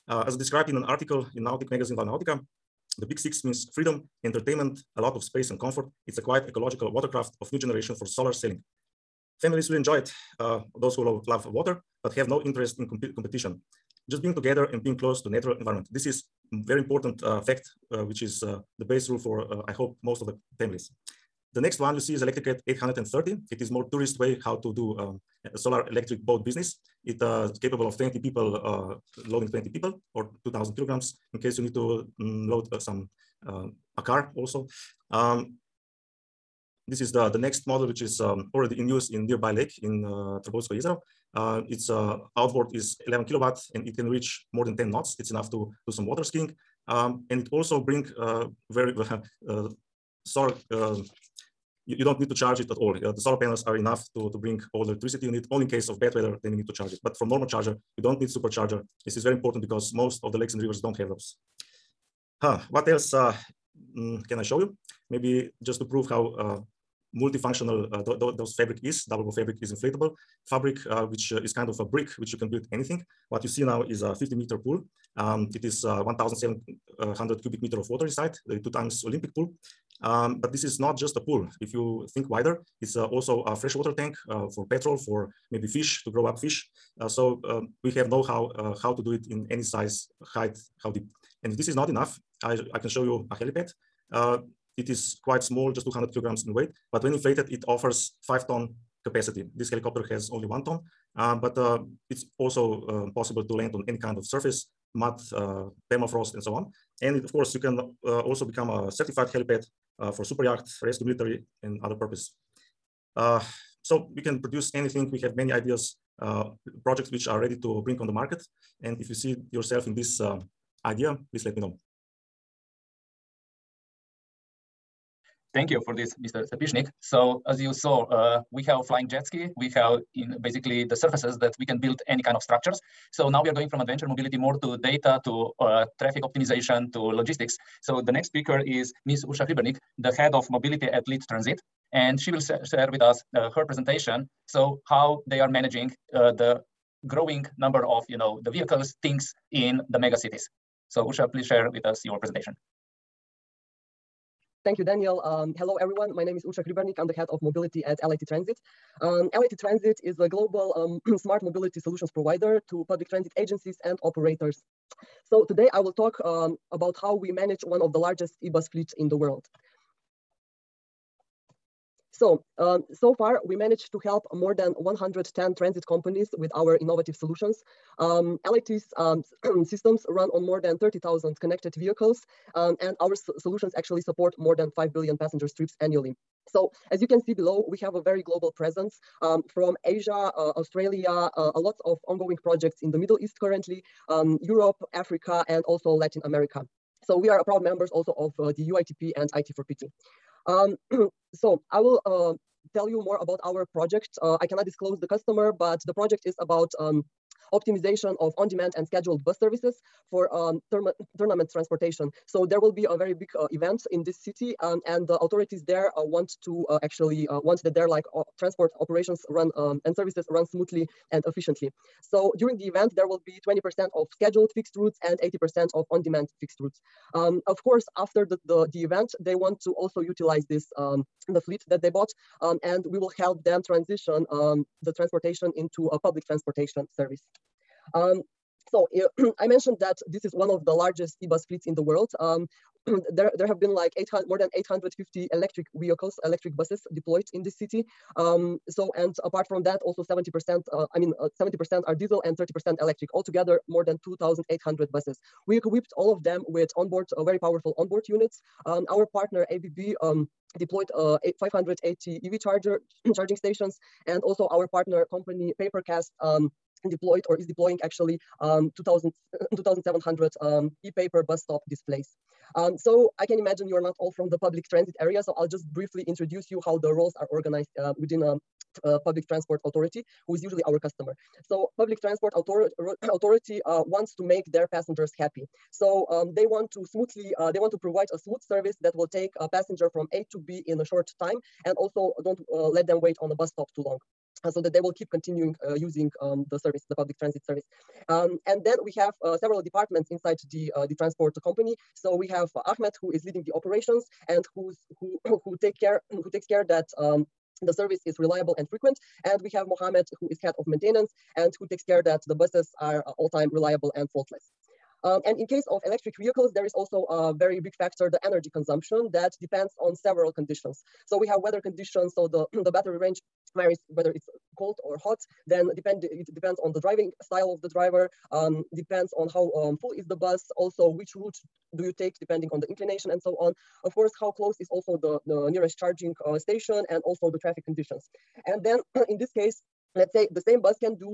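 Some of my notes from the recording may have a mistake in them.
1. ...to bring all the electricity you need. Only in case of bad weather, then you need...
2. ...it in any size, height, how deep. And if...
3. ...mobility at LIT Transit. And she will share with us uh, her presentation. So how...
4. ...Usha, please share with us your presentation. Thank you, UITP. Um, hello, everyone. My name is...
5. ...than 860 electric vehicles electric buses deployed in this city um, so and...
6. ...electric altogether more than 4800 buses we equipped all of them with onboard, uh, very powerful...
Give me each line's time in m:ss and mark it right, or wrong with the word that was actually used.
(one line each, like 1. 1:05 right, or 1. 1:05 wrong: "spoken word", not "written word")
1. 0:54 right
2. 1:29 right
3. 2:20 right
4. 2:31 wrong: "Daniel", not "UITP"
5. 4:04 wrong: "850", not "860"
6. 4:12 wrong: "2800", not "4800".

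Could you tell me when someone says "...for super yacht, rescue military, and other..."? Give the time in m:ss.
1:50.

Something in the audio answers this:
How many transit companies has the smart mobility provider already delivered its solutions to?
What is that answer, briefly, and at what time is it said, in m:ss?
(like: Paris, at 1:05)
More than 110, at 2:54.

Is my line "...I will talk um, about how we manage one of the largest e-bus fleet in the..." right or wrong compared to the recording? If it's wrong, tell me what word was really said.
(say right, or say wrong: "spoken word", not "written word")
right.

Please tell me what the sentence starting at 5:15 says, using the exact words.
Um, and in case of electric vehicles, there is also a very big factor, the energy consumption that depends on several conditions.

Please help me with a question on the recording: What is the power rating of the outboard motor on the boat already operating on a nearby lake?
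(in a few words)
11 kilowatts.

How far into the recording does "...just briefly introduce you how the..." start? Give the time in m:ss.
4:35.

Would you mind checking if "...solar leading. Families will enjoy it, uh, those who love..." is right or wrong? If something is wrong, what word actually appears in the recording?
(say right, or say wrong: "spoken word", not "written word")
wrong: "sailing", not "leading".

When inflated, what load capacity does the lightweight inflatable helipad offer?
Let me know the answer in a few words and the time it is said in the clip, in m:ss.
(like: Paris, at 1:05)
5 tons, at 1:38.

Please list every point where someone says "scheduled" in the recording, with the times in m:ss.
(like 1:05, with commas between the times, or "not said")
3:28, 3:44.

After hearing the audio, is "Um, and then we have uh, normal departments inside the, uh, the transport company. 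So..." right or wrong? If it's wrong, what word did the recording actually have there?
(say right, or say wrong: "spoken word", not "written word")
wrong: "several", not "normal".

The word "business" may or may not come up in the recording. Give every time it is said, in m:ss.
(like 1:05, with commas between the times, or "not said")
0:26.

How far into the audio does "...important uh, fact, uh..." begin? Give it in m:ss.
0:16.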